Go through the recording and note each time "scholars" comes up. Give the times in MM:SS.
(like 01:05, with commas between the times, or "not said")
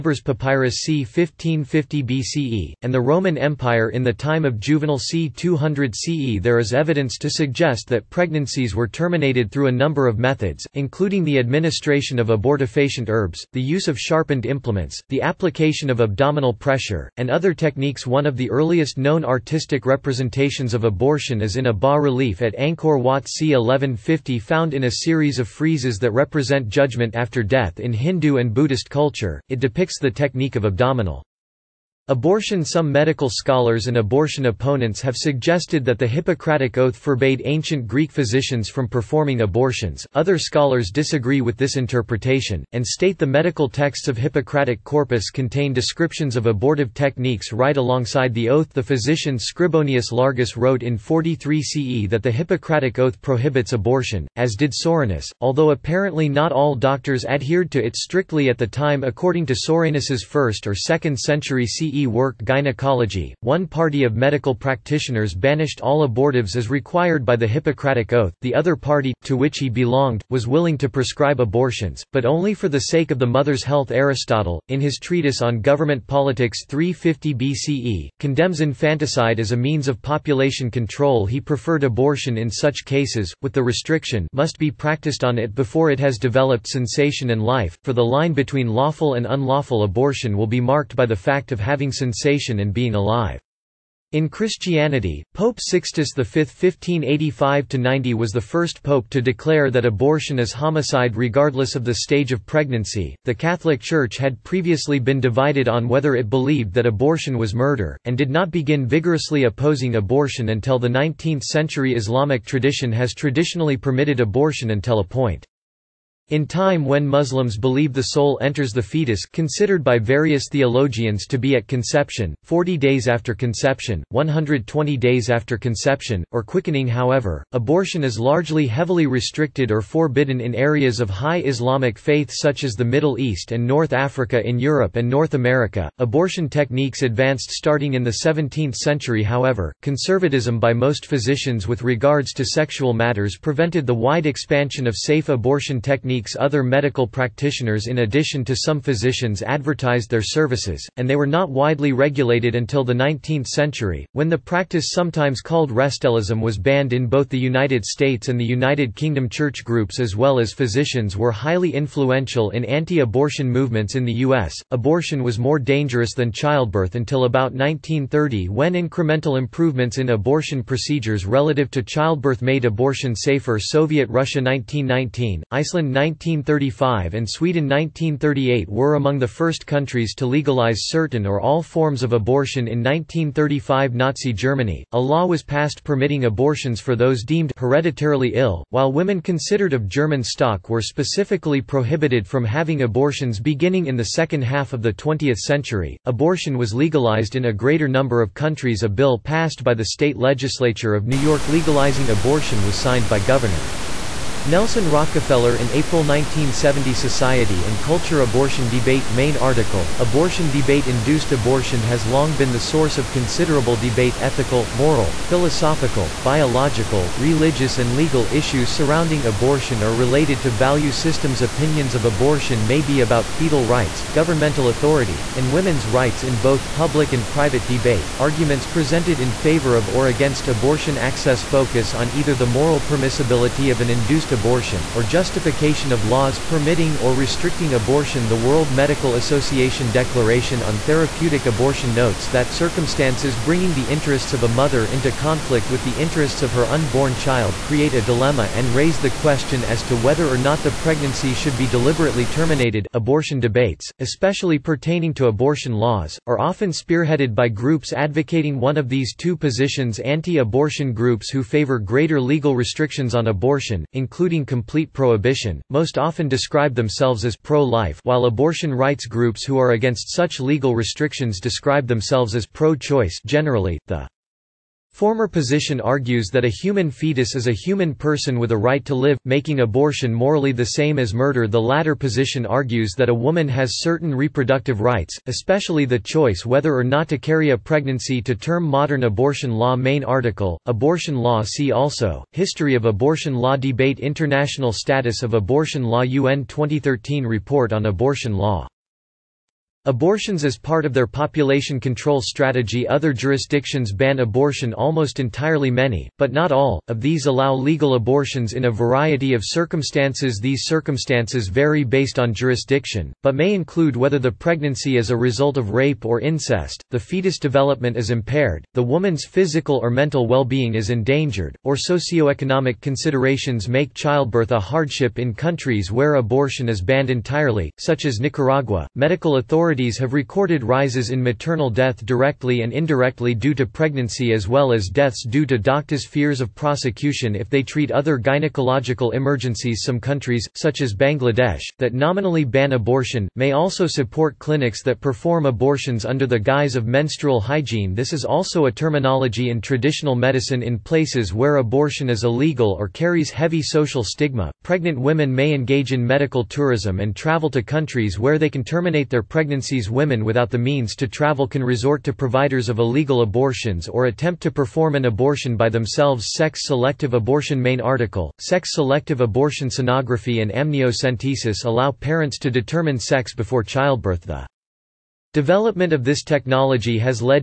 00:33, 00:40.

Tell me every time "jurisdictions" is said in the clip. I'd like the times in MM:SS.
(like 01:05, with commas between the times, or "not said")
05:03, 05:12.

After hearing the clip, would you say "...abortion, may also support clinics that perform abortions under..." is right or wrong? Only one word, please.
right.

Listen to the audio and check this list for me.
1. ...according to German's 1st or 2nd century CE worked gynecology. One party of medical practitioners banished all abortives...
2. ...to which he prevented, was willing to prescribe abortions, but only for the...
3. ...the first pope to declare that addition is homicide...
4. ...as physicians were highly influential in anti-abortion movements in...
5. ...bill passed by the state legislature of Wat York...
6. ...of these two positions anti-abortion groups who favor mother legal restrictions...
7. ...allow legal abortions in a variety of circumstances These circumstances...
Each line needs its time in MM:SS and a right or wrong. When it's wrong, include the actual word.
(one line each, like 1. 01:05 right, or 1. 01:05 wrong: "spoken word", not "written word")
1. 00:59 wrong: "Soranus", not "German"
2. 01:09 wrong: "belonged", not "prevented"
3. 01:38 wrong: "abortion", not "addition"
4. 02:40 right
5. 03:18 wrong: "New", not "Wat"
6. 04:18 wrong: "greater", not "mother"
7. 05:07 right.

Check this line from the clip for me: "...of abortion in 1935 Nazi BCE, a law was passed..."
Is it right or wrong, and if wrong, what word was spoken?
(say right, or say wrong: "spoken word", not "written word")
wrong: "Germany", not "BCE".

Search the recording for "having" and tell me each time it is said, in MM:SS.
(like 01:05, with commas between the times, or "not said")
01:31, 03:12.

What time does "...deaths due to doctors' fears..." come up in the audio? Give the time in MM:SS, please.
05:34.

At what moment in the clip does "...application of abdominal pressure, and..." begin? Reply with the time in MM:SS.
00:15.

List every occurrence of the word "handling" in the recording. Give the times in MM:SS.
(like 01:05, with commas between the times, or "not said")
not said.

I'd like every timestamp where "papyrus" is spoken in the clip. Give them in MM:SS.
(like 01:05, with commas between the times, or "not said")
00:00.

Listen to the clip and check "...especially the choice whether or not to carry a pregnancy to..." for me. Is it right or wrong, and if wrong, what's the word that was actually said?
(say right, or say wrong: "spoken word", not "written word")
right.